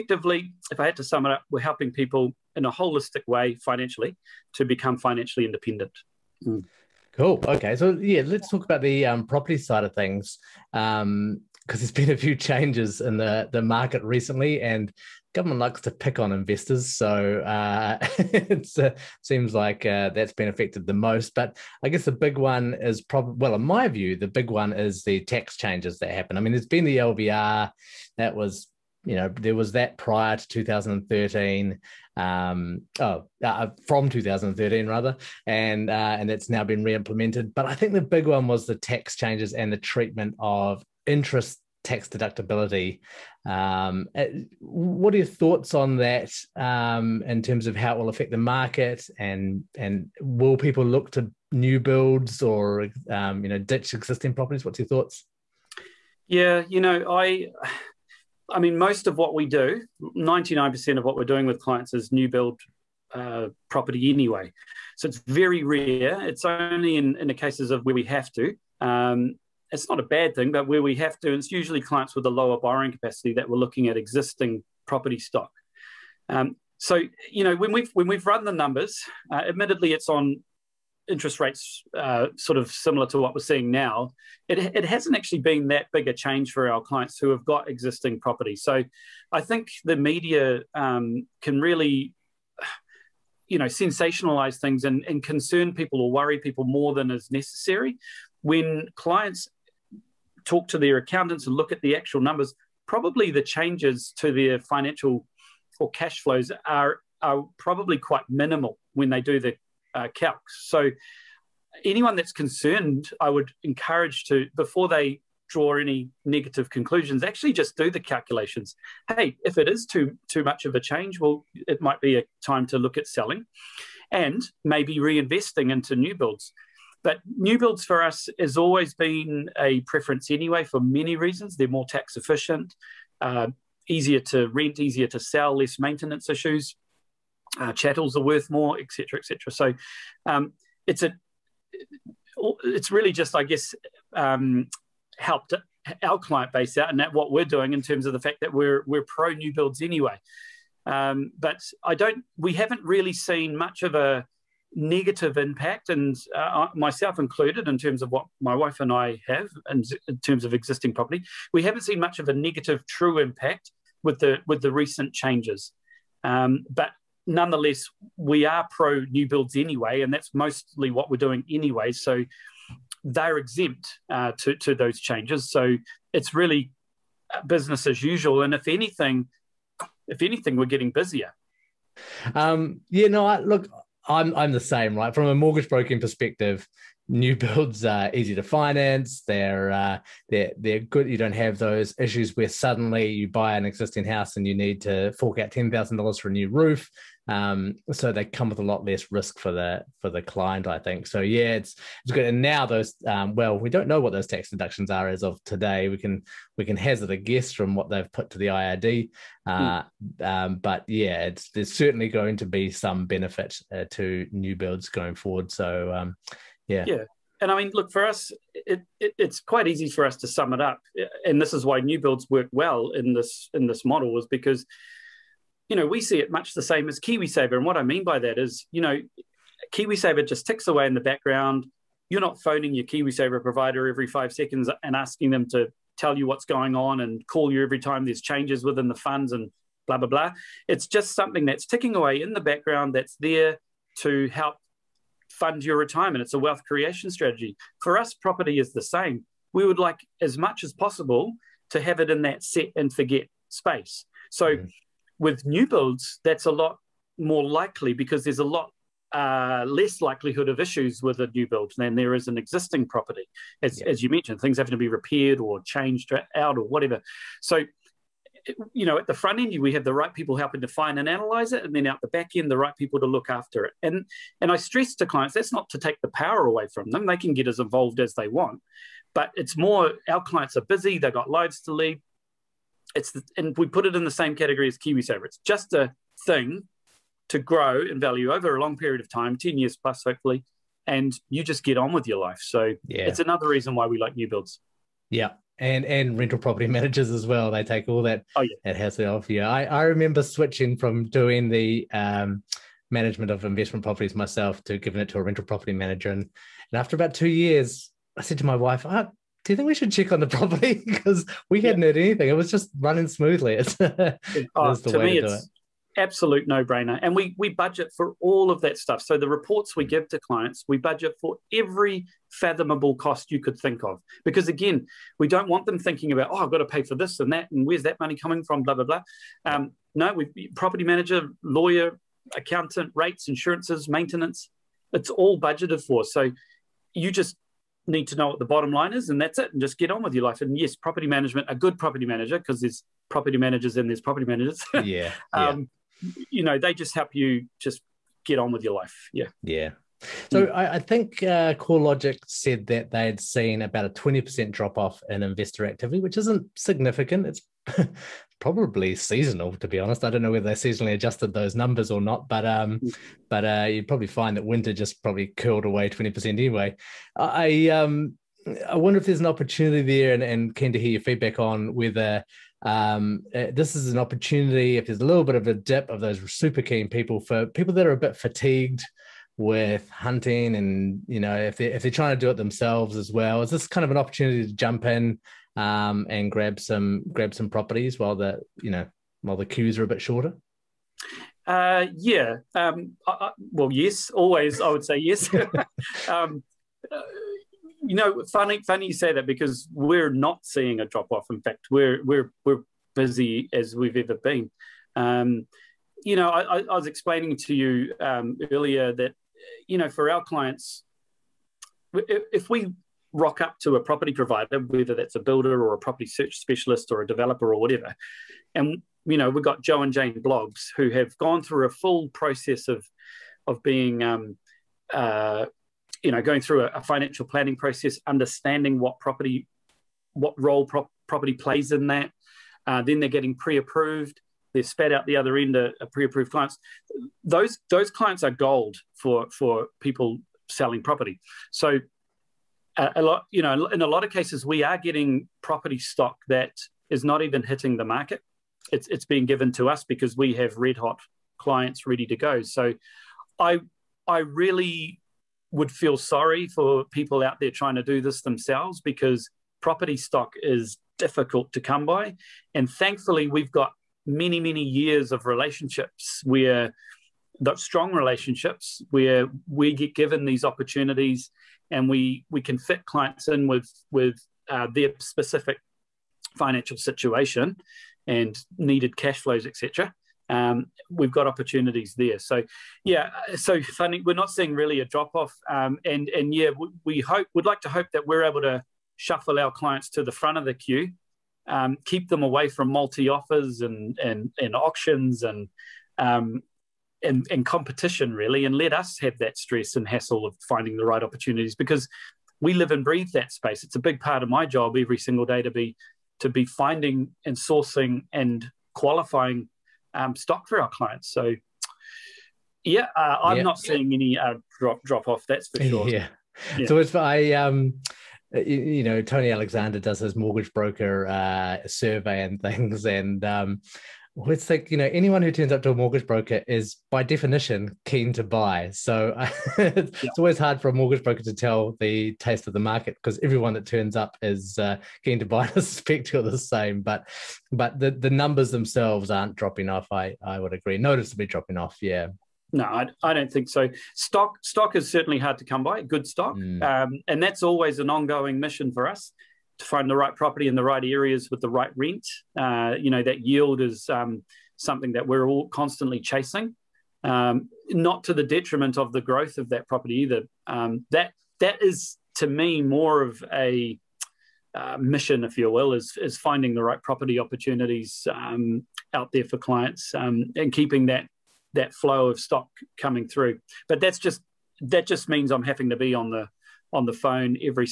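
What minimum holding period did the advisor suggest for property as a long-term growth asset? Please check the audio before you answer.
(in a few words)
10 years.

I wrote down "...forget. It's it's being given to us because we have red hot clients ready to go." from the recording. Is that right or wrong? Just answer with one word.
wrong.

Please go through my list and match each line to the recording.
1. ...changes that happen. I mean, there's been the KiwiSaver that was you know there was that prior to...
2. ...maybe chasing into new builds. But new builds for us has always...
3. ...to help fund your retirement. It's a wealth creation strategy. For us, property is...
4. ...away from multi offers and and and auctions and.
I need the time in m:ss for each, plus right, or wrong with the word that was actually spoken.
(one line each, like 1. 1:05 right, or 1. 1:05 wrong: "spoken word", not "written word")
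1. 0:25 wrong: "LVR", not "KiwiSaver"
2. 2:04 wrong: "reinvesting", not "chasing"
3. 4:03 right
4. 8:12 right.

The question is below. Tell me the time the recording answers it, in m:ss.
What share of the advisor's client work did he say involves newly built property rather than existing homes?
1:00.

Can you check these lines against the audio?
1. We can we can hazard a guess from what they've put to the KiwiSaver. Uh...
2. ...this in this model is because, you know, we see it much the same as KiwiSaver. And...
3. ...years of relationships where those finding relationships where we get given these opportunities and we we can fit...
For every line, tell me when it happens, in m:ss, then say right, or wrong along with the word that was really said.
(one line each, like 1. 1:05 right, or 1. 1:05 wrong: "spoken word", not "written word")
1. 3:25 wrong: "IRD", not "KiwiSaver"
2. 3:43 right
3. 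7:44 wrong: "strong", not "finding".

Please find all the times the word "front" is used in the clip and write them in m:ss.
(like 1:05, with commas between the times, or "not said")
4:29, 8:10.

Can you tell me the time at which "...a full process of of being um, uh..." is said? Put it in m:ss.
7:01.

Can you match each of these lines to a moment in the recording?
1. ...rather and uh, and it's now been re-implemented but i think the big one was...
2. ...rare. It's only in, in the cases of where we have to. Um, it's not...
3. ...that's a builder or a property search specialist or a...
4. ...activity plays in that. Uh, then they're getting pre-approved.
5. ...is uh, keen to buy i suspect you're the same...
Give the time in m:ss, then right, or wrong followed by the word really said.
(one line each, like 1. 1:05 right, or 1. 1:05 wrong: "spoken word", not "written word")
1. 0:34 right
2. 1:05 right
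3. 6:54 right
4. 7:11 wrong: "property", not "activity"
5. 8:54 right.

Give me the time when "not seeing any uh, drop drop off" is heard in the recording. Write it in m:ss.
8:33.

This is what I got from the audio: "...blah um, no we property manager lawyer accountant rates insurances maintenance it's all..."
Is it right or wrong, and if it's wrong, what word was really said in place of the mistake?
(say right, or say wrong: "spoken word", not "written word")
right.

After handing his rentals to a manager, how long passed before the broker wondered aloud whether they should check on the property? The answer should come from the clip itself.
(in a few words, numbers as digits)
2 years.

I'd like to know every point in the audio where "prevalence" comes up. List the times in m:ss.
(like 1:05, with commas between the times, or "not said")
not said.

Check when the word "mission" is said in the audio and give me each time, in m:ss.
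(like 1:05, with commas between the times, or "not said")
9:08, 9:24.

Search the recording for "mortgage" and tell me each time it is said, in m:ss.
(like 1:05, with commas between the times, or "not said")
3:05, 8:40, 8:45, 8:50.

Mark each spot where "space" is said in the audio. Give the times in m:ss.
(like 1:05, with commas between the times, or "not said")
4:13, 8:23.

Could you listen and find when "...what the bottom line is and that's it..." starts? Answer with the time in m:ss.
5:38.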